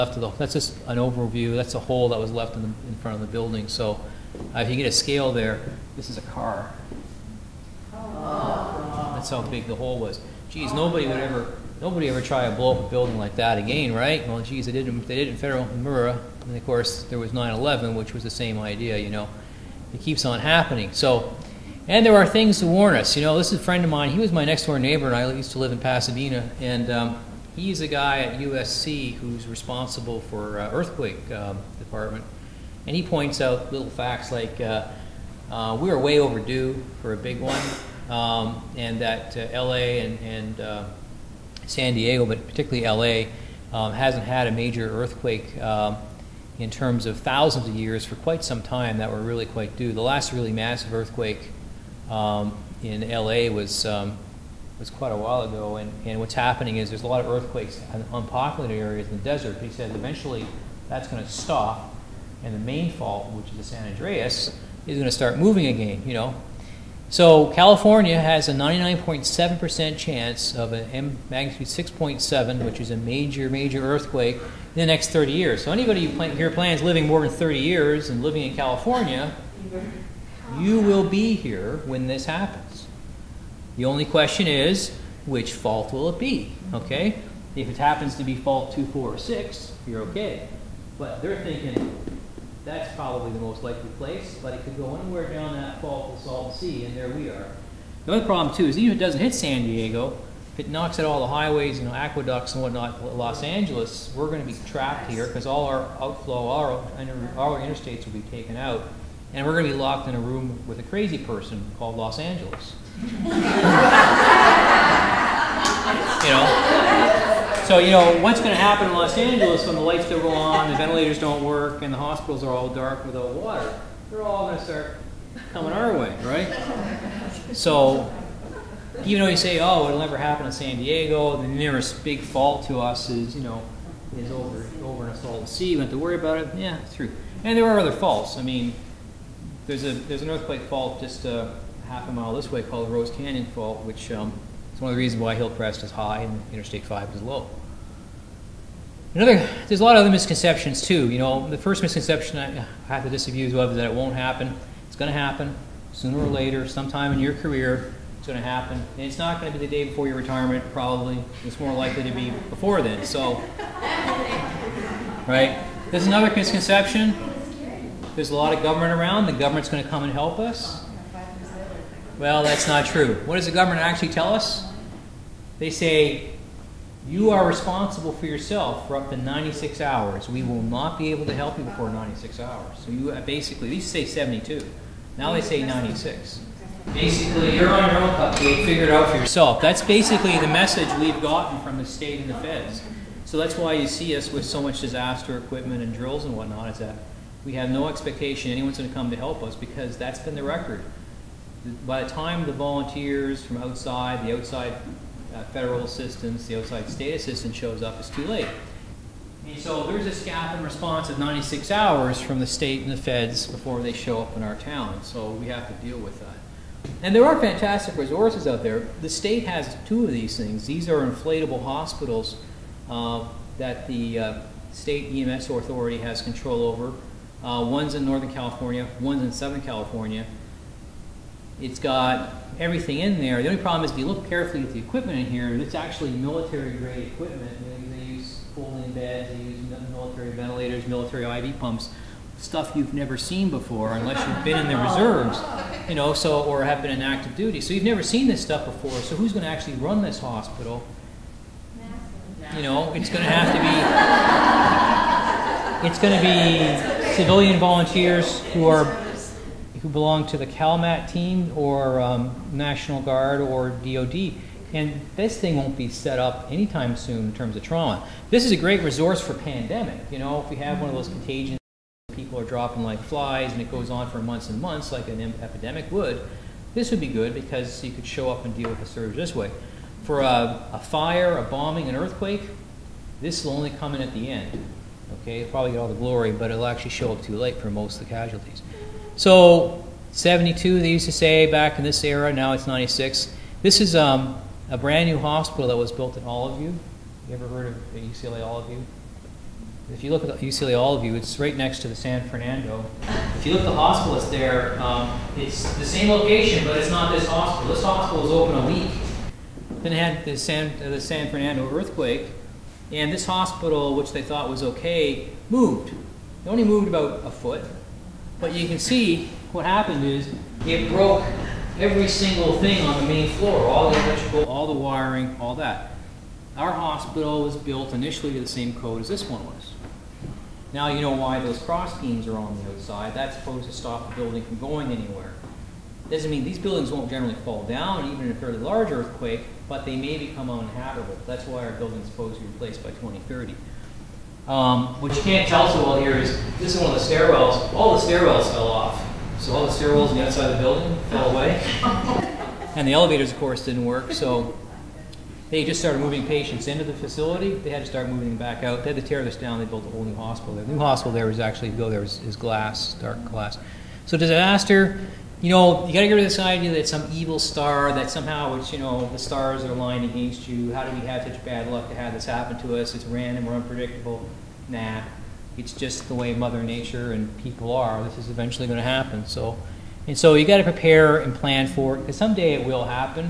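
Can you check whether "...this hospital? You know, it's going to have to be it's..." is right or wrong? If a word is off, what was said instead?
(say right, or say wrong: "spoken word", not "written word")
right.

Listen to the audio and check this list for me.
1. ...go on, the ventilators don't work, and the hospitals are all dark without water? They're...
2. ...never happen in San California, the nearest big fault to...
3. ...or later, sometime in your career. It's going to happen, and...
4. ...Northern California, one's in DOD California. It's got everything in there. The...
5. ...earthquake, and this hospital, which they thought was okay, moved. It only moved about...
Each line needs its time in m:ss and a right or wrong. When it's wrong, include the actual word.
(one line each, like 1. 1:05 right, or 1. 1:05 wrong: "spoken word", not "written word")
1. 2:00 right
2. 2:10 wrong: "Diego", not "California"
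3. 2:36 right
4. 3:48 wrong: "Southern", not "DOD"
5. 5:11 right.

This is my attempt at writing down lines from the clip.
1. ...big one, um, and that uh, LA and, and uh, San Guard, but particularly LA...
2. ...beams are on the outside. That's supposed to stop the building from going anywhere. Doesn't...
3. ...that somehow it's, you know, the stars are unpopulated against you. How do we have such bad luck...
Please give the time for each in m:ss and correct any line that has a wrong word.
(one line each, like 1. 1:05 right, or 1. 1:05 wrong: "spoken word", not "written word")
1. 0:37 wrong: "Diego", not "Guard"
2. 5:32 right
3. 6:07 wrong: "aligned", not "unpopulated".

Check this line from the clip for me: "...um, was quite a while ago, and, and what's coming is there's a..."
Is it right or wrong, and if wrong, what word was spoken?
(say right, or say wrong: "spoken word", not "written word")
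wrong: "happening", not "coming".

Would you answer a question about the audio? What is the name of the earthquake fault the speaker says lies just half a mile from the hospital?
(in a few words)
Rose Canyon Fault.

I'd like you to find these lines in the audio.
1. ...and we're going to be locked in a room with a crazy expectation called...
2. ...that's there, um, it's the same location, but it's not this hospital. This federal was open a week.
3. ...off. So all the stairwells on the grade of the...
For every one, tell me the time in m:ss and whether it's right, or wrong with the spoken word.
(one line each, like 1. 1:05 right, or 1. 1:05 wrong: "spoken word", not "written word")
1. 1:49 wrong: "person", not "expectation"
2. 5:04 wrong: "hospital", not "federal"
3. 5:48 wrong: "outside", not "grade".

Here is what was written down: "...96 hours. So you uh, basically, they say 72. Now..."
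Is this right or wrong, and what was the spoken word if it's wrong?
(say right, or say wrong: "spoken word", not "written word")
right.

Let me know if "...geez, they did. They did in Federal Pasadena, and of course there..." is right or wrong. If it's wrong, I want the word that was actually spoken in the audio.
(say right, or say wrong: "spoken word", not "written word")
wrong: "Murrah", not "Pasadena".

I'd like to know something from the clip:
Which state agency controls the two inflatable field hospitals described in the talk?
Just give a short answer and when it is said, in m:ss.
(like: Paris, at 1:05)
state EMS authority, at 3:44.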